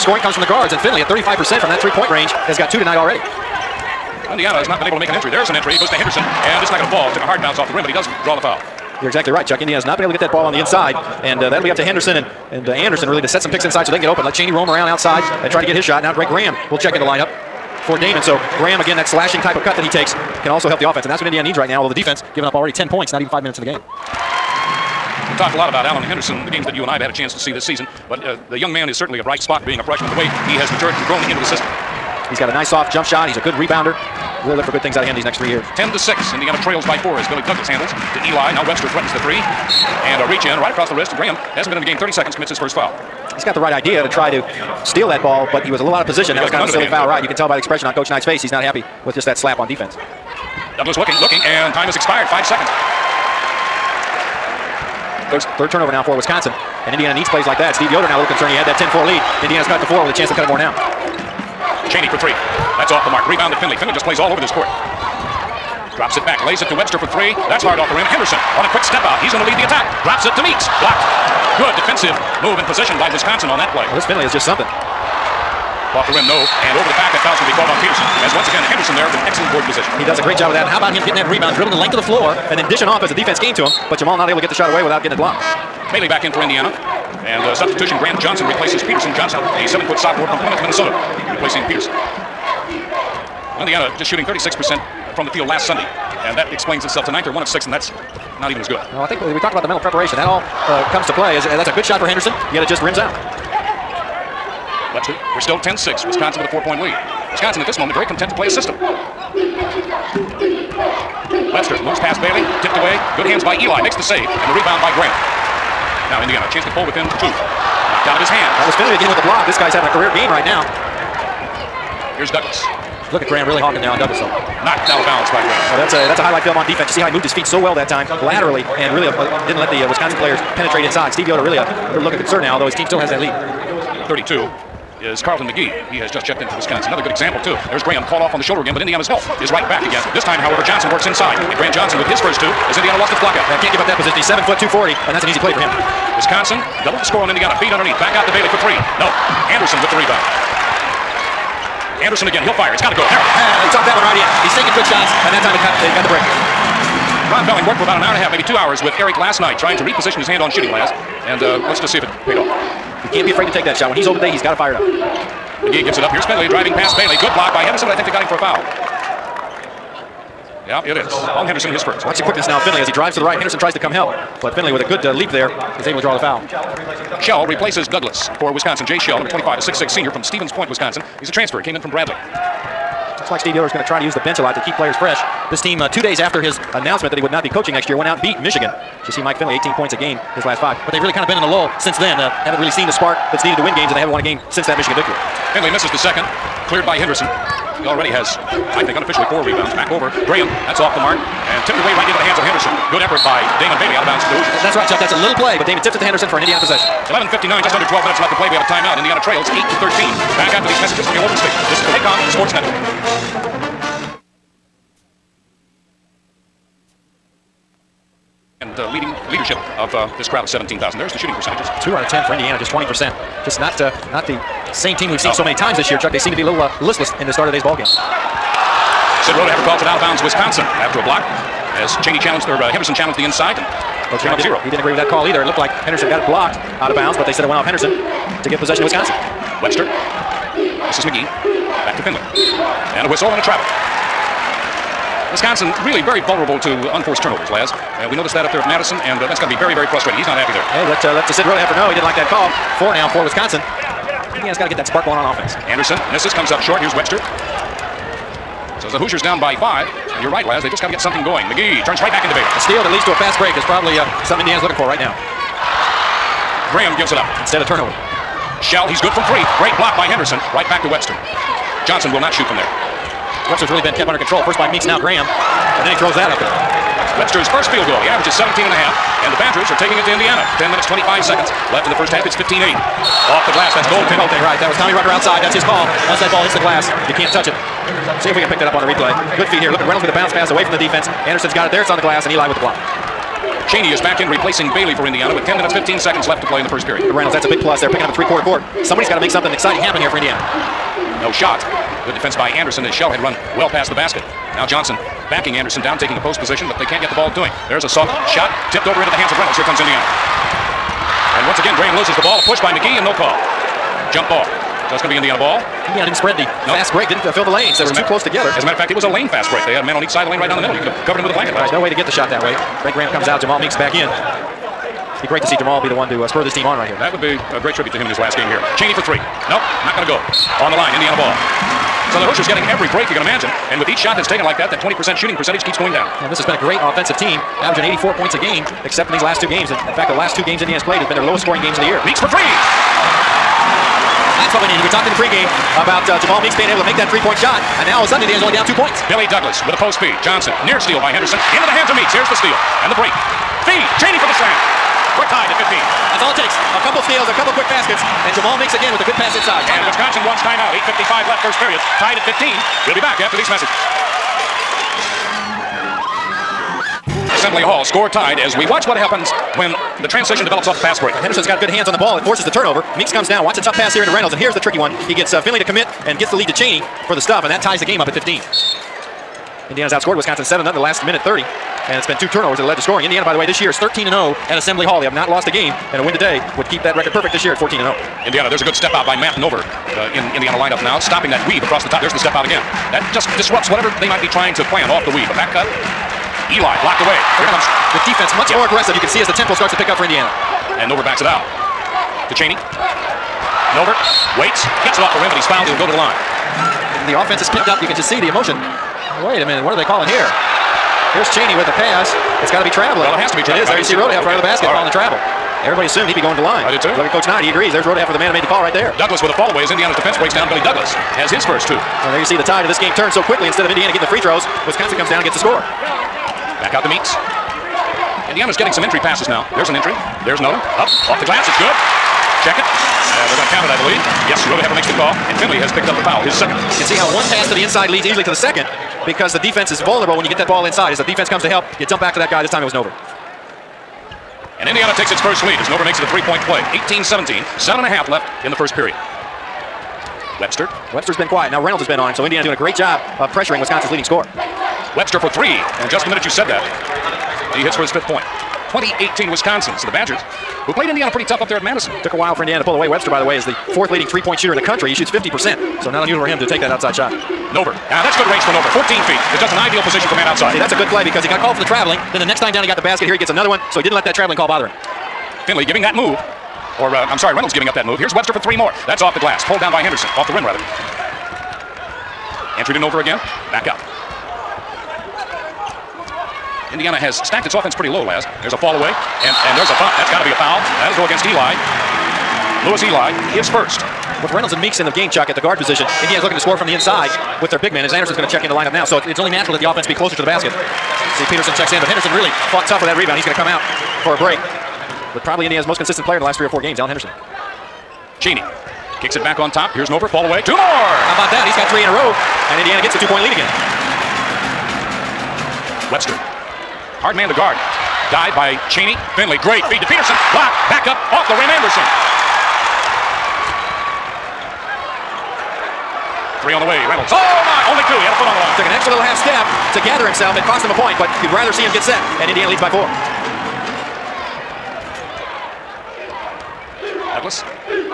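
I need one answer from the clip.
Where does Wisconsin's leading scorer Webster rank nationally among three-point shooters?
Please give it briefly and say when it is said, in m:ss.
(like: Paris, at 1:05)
Fourth, at 7:43.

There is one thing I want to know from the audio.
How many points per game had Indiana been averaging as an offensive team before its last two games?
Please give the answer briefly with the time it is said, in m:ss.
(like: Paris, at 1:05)
84, at 5:37.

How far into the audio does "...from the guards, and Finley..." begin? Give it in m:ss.
0:00.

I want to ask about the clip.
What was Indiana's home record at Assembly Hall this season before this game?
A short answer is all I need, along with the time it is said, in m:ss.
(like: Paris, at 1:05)
13-0, at 6:23.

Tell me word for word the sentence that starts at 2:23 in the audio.
Yeah, can't give up that position.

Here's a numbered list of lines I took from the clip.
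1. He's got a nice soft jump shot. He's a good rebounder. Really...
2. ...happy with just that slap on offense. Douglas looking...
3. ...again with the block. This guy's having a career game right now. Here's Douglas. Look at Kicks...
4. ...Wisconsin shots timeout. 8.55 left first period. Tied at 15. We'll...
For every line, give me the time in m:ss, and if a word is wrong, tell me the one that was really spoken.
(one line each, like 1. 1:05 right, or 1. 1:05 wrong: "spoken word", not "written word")
1. 0:32 right
2. 0:48 wrong: "defense", not "offense"
3. 1:58 wrong: "Graham", not "Kicks"
4. 5:59 wrong: "wants", not "shots".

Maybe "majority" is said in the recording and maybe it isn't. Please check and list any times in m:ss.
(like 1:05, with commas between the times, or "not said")
not said.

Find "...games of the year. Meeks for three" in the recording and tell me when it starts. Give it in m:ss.
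5:41.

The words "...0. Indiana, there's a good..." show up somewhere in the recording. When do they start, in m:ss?
6:27.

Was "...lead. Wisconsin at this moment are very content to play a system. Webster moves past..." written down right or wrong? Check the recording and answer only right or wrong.
right.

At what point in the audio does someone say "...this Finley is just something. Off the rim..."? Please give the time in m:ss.
1:13.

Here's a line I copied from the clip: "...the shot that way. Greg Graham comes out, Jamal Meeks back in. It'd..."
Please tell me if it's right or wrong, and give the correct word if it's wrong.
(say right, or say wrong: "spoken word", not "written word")
right.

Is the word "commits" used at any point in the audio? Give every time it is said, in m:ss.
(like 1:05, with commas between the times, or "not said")
0:42, 6:15.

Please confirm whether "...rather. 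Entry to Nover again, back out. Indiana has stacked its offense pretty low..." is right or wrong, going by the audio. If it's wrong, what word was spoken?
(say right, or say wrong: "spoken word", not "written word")
right.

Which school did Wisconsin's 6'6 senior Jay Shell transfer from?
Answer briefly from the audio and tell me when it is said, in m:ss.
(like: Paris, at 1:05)
Bradley, at 3:01.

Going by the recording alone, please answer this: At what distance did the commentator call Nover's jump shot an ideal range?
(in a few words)
14 feet.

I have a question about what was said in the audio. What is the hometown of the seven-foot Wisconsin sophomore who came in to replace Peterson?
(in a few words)
Plymouth, Minnesota.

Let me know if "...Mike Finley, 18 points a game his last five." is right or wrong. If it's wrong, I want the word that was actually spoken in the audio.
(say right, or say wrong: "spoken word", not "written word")
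right.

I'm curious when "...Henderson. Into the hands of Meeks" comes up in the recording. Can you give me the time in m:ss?
5:51.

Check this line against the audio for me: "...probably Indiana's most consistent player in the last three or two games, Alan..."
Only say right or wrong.
wrong.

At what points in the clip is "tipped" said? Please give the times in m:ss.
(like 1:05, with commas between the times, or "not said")
1:52, 3:21, 5:08.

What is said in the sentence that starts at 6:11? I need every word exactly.
And Henderson's got good hands on the ball.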